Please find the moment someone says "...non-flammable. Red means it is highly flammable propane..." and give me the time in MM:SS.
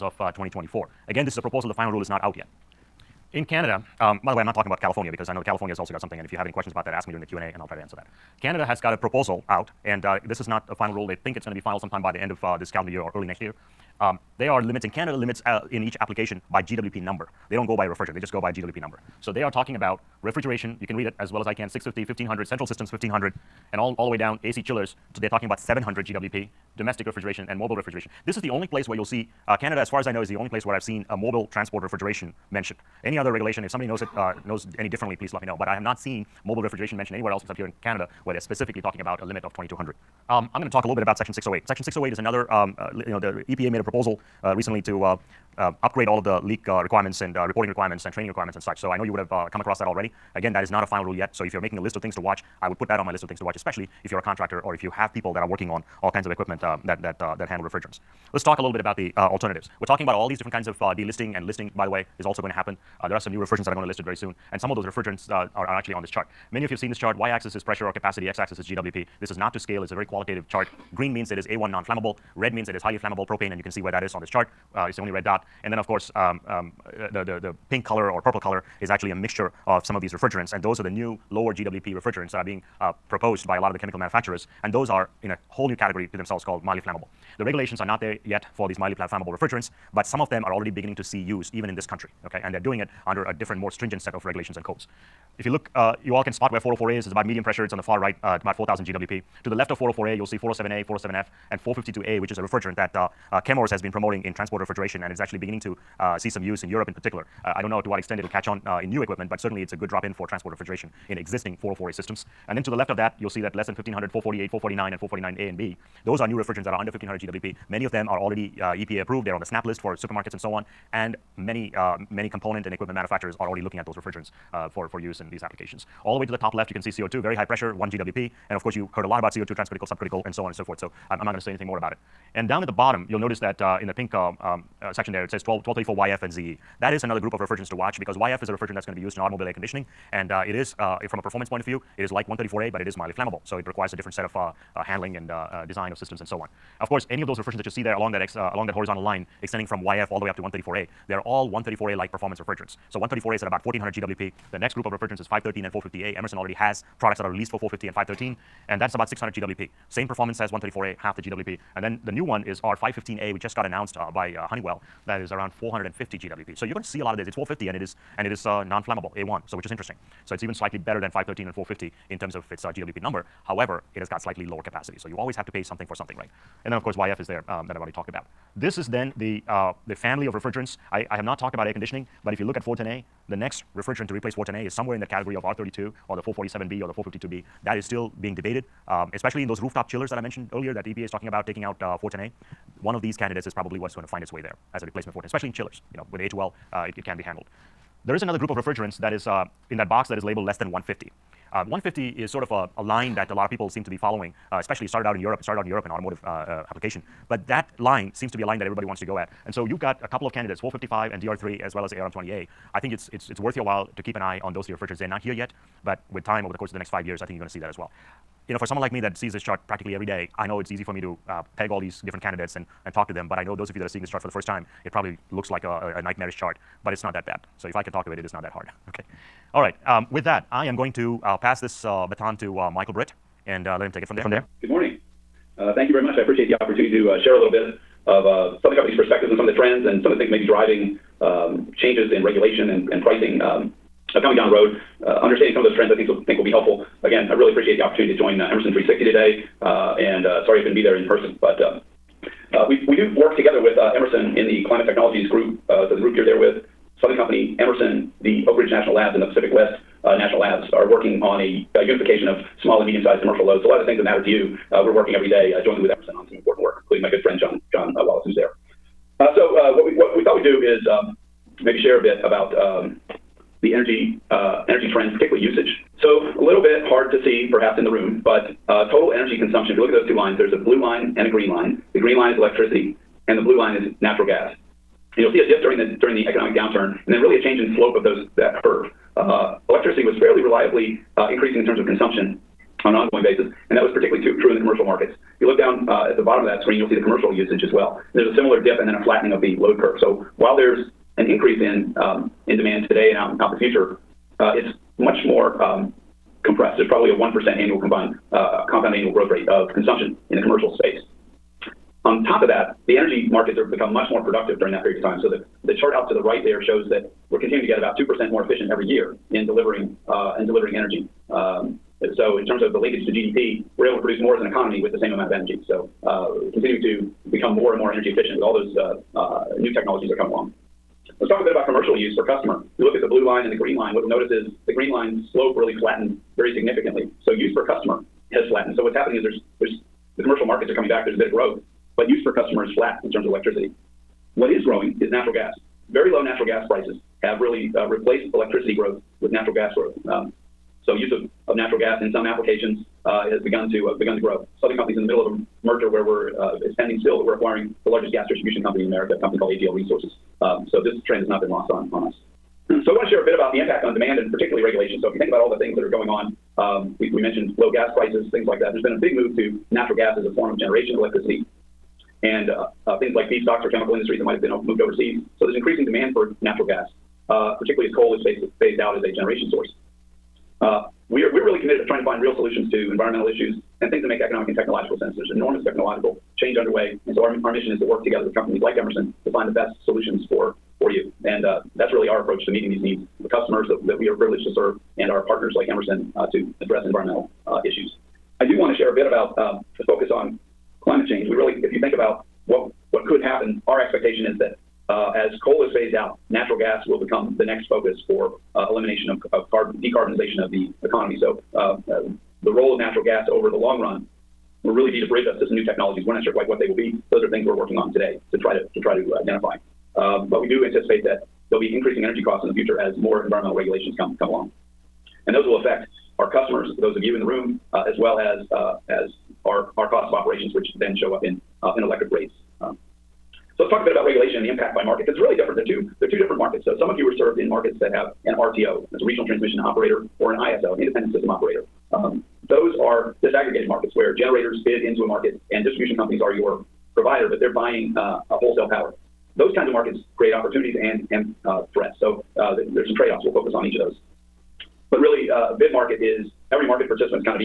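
01:11.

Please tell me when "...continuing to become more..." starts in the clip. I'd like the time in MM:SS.
05:26.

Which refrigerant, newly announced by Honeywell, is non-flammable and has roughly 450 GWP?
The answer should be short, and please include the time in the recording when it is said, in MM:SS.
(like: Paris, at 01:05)
R-515A, at 02:42.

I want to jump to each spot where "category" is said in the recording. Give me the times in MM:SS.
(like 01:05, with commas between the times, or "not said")
01:25, 03:05.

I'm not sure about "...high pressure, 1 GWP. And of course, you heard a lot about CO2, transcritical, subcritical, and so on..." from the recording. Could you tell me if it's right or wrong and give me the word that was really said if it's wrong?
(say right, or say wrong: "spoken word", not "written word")
right.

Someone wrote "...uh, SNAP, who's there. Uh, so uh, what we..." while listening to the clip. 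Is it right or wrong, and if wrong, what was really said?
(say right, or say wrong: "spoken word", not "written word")
wrong: "Wallace", not "SNAP".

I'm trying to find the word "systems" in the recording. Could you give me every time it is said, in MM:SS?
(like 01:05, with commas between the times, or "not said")
00:22, 01:51, 02:25, 07:21.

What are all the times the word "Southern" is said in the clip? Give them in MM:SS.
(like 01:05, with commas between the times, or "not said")
03:58, 04:17, 05:54.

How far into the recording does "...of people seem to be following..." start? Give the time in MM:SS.
03:23.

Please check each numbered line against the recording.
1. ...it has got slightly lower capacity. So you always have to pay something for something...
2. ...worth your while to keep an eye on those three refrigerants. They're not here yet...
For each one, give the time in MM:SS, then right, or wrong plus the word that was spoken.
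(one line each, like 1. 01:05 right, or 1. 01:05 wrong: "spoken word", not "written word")
1. 02:53 right
2. 03:33 right.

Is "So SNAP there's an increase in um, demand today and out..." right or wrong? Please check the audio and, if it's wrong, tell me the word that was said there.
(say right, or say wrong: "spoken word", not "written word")
wrong: "While", not "SNAP".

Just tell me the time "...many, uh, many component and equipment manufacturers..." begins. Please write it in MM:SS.
02:01.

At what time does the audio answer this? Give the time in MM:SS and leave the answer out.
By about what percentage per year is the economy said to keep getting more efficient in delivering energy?
05:17.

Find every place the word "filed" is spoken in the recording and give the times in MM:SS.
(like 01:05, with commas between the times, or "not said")
00:11.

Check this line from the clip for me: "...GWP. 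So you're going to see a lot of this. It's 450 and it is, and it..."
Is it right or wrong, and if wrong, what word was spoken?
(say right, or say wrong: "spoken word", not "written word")
right.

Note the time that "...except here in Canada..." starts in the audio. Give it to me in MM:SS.
00:37.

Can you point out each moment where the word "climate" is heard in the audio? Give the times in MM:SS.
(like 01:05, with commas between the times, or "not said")
04:14, 06:40.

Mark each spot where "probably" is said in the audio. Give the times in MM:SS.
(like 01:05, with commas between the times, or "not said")
03:13, 03:44, 05:06.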